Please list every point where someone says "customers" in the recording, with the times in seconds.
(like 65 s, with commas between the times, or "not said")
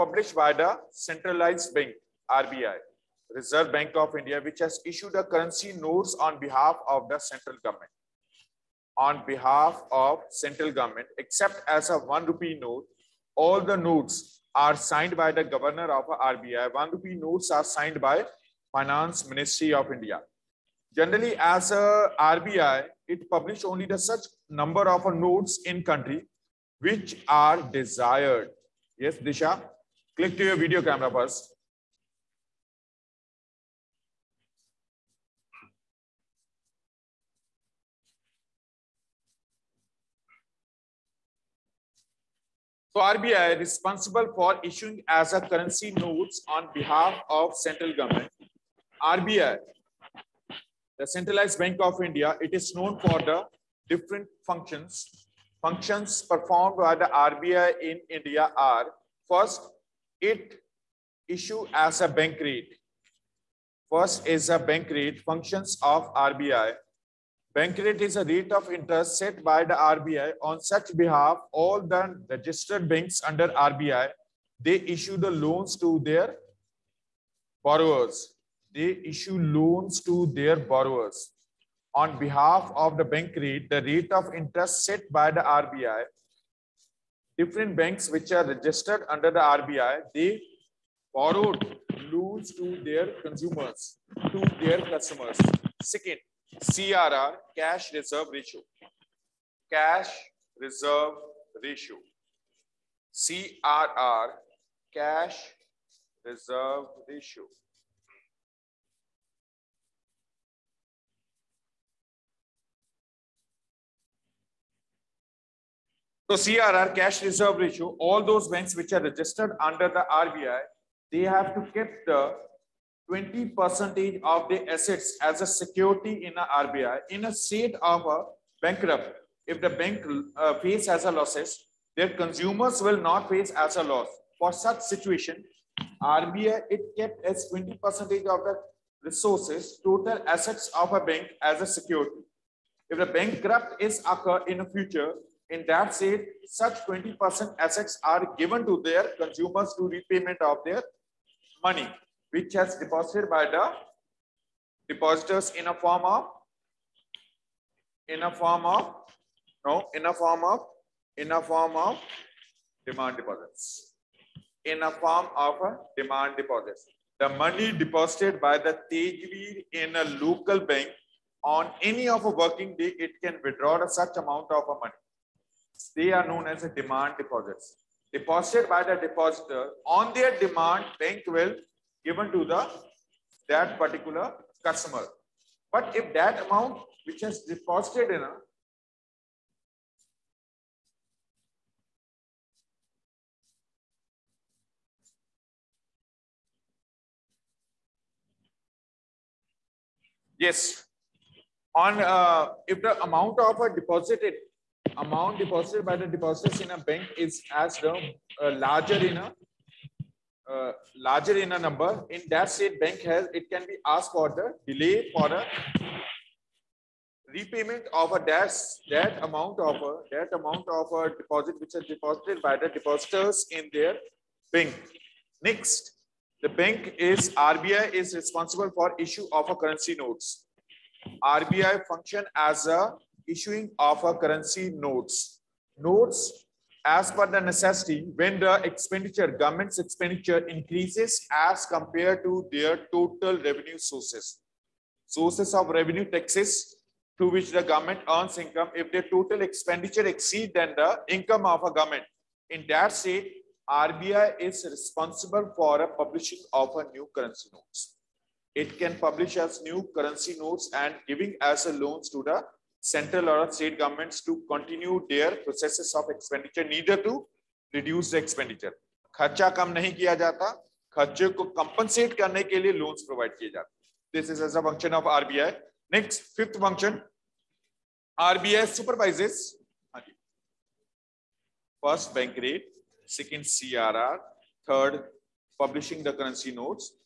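94 s, 184 s.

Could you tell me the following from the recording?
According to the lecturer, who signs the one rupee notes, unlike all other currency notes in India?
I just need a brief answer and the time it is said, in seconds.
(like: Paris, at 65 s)
Finance Ministry of India, at 18 s.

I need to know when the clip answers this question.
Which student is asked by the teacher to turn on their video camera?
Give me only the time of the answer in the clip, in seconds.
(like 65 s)
29 s.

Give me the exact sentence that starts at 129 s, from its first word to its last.
If the bank uh, face as a losses, their consumers will not face as a loss.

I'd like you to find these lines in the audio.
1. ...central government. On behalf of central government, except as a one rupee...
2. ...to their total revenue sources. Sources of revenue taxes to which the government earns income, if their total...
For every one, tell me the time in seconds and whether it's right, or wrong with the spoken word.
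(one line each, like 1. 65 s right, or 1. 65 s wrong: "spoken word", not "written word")
1. 7 s right
2. 242 s right.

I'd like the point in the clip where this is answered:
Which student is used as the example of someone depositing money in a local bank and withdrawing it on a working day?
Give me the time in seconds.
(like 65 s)
168 s.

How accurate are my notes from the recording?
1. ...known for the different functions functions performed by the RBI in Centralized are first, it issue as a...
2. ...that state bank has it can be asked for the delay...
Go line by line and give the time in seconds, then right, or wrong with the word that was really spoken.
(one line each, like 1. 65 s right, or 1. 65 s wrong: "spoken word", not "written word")
1. 52 s wrong: "India", not "Centralized"
2. 212 s right.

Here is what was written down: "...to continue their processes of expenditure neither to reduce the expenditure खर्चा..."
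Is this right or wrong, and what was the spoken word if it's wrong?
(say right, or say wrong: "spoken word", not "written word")
right.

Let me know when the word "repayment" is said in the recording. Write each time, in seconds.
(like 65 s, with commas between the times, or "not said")
149 s, 217 s.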